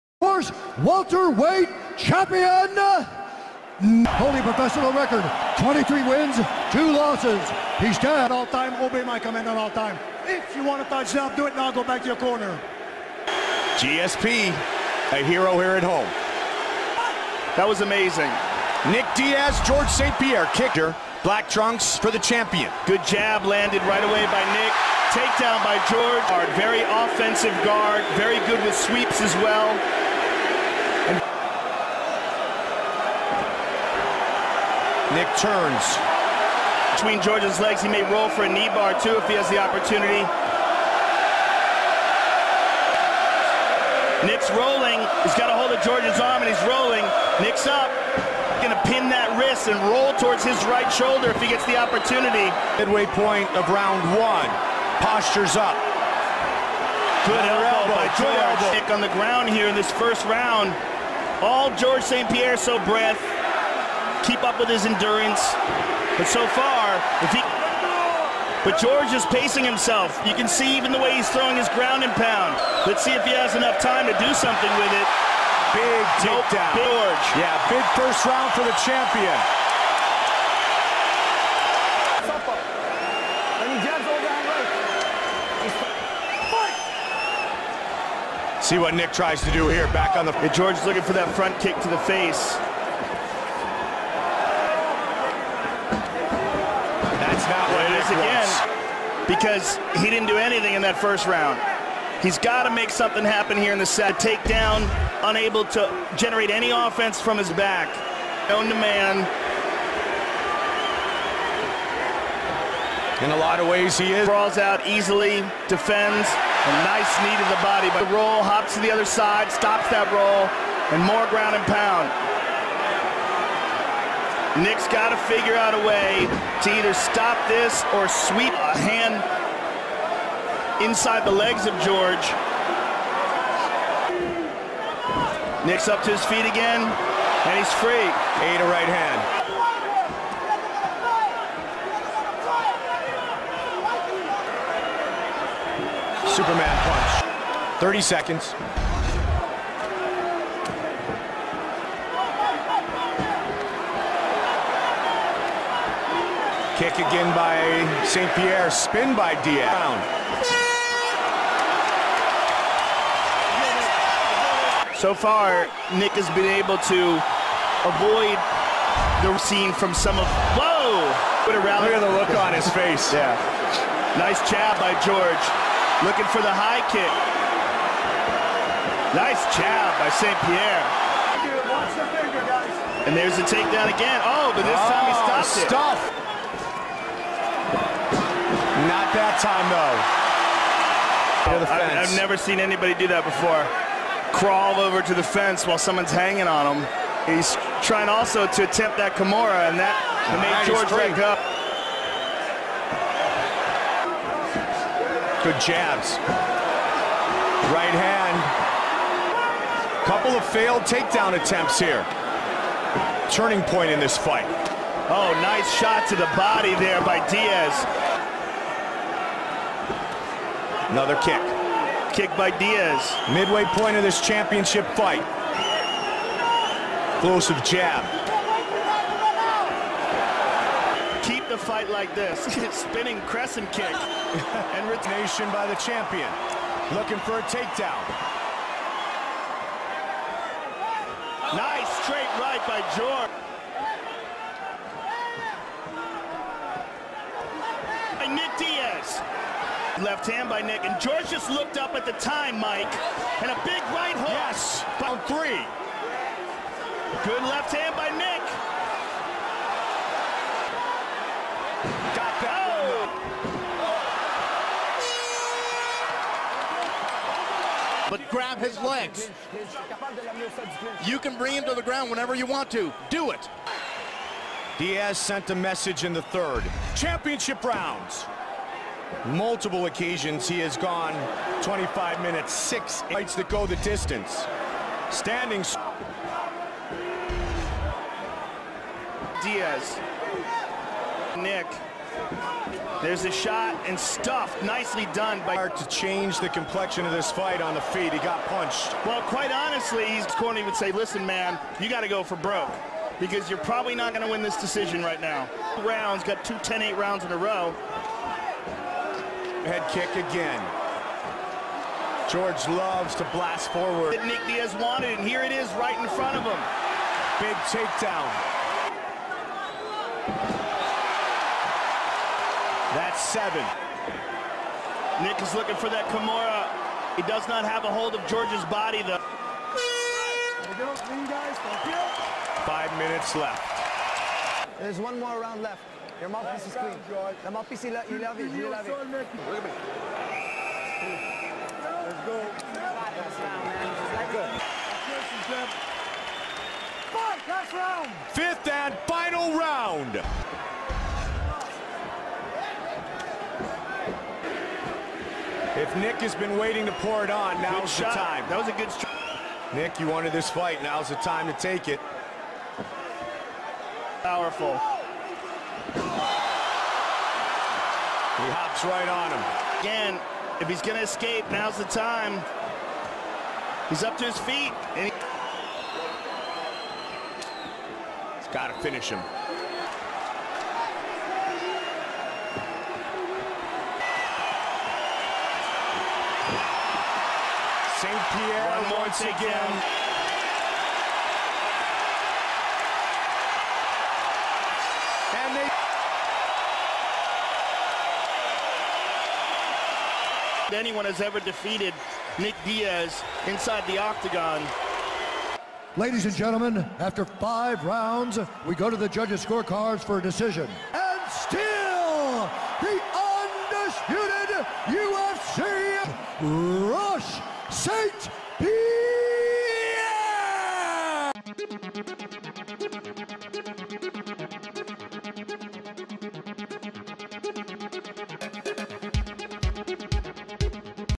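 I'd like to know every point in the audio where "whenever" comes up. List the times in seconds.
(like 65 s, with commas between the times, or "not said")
272 s.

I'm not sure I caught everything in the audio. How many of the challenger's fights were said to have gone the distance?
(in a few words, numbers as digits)
6.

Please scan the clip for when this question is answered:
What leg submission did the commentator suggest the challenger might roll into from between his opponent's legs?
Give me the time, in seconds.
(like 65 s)
38 s.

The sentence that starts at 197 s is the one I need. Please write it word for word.
He's trying also to attempt that Kimura, and that made right, George back up.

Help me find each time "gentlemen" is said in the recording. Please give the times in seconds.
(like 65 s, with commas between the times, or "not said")
406 s.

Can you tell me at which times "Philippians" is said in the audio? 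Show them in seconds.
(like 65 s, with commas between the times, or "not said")
not said.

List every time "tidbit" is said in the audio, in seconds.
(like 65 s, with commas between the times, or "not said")
not said.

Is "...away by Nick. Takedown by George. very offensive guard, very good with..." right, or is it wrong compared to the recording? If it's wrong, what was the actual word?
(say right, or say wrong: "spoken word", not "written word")
right.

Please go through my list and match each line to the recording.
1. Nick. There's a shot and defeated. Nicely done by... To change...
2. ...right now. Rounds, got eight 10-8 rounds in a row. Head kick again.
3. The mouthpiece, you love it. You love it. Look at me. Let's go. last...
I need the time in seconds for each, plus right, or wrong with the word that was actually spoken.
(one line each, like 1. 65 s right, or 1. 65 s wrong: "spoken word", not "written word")
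1. 291 s wrong: "stuffed", not "defeated"
2. 305 s wrong: "two", not "eight"
3. 337 s right.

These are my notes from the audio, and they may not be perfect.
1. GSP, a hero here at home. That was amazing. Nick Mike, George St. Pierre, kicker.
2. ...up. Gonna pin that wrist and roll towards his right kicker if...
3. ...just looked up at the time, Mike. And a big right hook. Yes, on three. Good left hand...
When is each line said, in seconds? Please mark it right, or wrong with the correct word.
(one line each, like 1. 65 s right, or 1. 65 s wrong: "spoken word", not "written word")
1. 13 s wrong: "Diaz", not "Mike"
2. 47 s wrong: "shoulder", not "kicker"
3. 251 s right.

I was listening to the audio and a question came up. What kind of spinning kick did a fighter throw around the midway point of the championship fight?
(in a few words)
Spinning crescent kick.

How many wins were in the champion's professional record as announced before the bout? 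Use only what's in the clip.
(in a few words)
23.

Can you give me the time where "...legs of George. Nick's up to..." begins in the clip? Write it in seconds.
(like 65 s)
131 s.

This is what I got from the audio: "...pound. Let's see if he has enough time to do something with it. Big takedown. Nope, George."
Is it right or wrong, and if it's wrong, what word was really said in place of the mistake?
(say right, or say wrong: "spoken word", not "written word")
right.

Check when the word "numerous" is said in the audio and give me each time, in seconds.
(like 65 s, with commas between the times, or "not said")
not said.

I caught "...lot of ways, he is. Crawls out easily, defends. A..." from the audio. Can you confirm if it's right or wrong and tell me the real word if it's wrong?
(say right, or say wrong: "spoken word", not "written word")
right.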